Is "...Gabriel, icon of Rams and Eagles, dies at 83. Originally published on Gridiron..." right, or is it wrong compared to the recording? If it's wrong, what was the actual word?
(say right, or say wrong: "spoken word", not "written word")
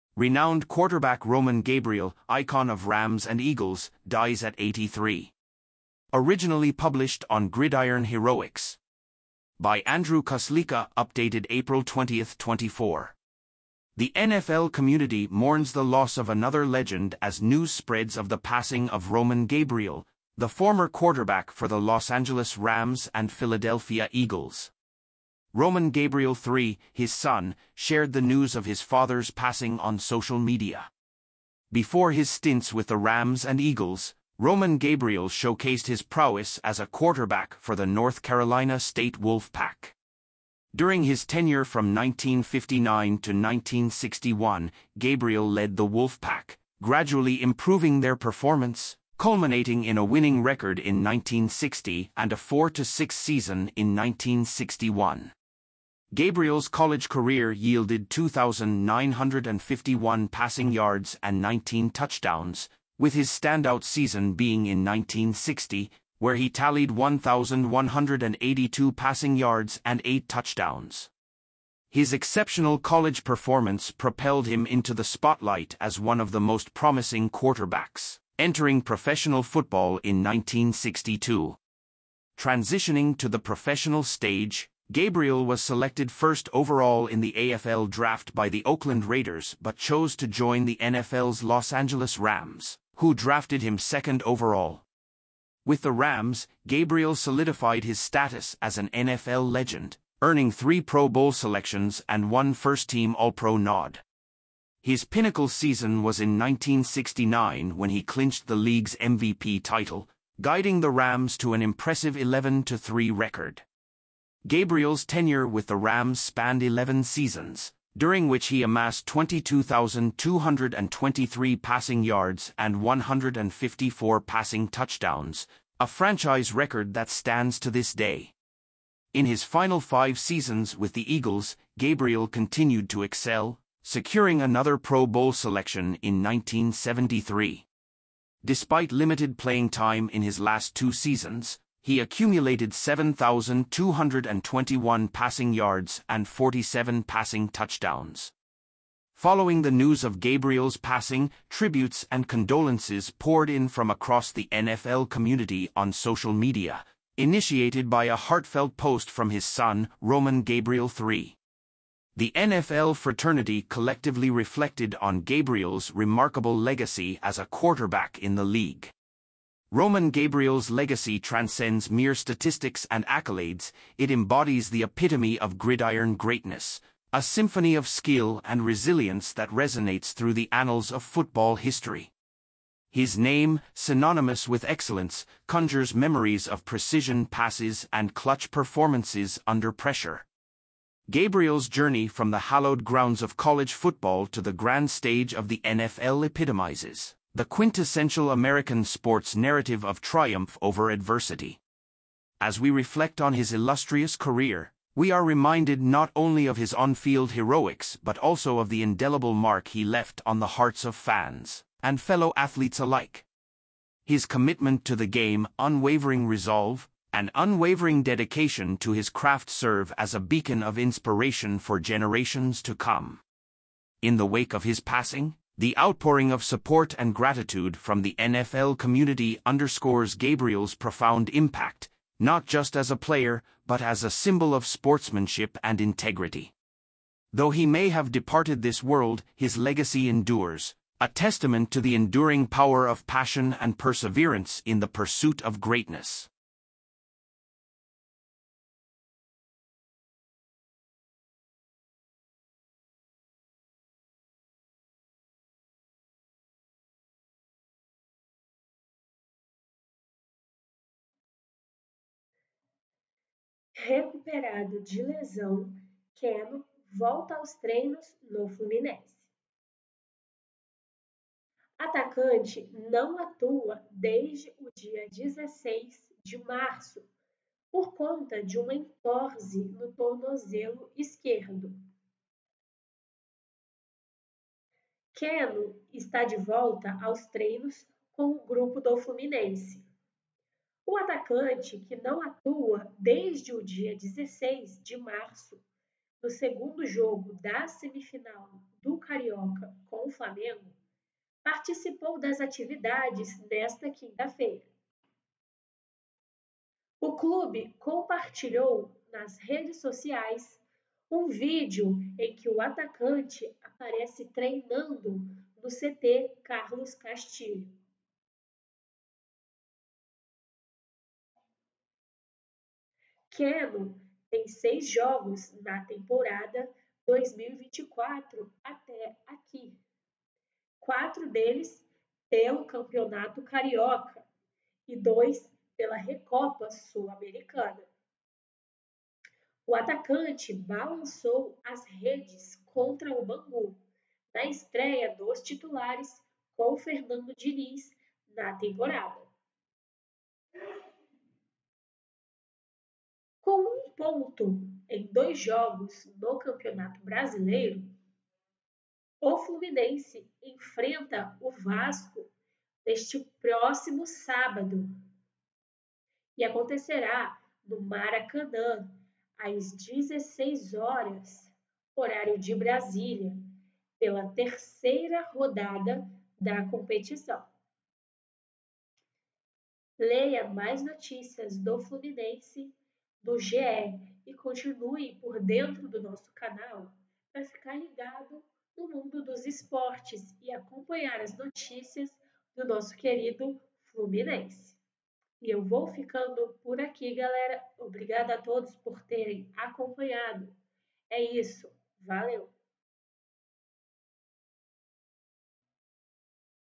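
right.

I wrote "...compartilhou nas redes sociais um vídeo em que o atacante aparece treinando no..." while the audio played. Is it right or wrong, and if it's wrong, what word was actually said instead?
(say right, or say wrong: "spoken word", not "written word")
right.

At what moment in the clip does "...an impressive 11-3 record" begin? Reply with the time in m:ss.
1:51.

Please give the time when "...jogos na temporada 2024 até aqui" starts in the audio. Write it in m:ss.
5:24.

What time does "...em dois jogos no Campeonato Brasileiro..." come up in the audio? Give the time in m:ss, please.
5:54.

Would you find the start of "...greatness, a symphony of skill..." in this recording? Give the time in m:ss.
2:56.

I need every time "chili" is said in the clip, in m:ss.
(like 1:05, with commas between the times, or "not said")
not said.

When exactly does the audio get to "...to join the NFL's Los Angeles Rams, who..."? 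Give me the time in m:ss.
1:30.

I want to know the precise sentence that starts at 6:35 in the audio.
E eu vou ficando por aqui, galera.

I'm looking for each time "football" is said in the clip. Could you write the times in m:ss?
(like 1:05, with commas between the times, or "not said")
1:19, 3:01, 3:13.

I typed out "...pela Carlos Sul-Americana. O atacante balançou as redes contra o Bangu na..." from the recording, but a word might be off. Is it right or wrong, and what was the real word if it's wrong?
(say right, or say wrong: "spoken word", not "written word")
wrong: "Recopa", not "Carlos".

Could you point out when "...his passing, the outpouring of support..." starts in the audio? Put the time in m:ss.
3:44.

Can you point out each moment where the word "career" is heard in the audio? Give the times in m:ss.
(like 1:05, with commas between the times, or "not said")
0:57, 3:24.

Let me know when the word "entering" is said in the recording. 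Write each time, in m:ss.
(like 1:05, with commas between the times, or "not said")
1:18.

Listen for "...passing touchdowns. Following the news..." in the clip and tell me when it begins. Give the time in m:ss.
2:27.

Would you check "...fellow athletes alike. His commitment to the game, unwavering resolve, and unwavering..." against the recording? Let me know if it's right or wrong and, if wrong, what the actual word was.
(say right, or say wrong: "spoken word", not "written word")
right.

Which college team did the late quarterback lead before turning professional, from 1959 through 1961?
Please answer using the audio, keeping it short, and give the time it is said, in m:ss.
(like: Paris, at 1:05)
North Carolina State Wolfpack, at 0:37.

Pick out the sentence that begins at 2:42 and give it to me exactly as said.
The NFL fraternity collectively reflected on Gabriel's remarkable legacy as a quarterback in the league.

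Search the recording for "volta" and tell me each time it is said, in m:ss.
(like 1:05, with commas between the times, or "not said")
4:26, 4:46.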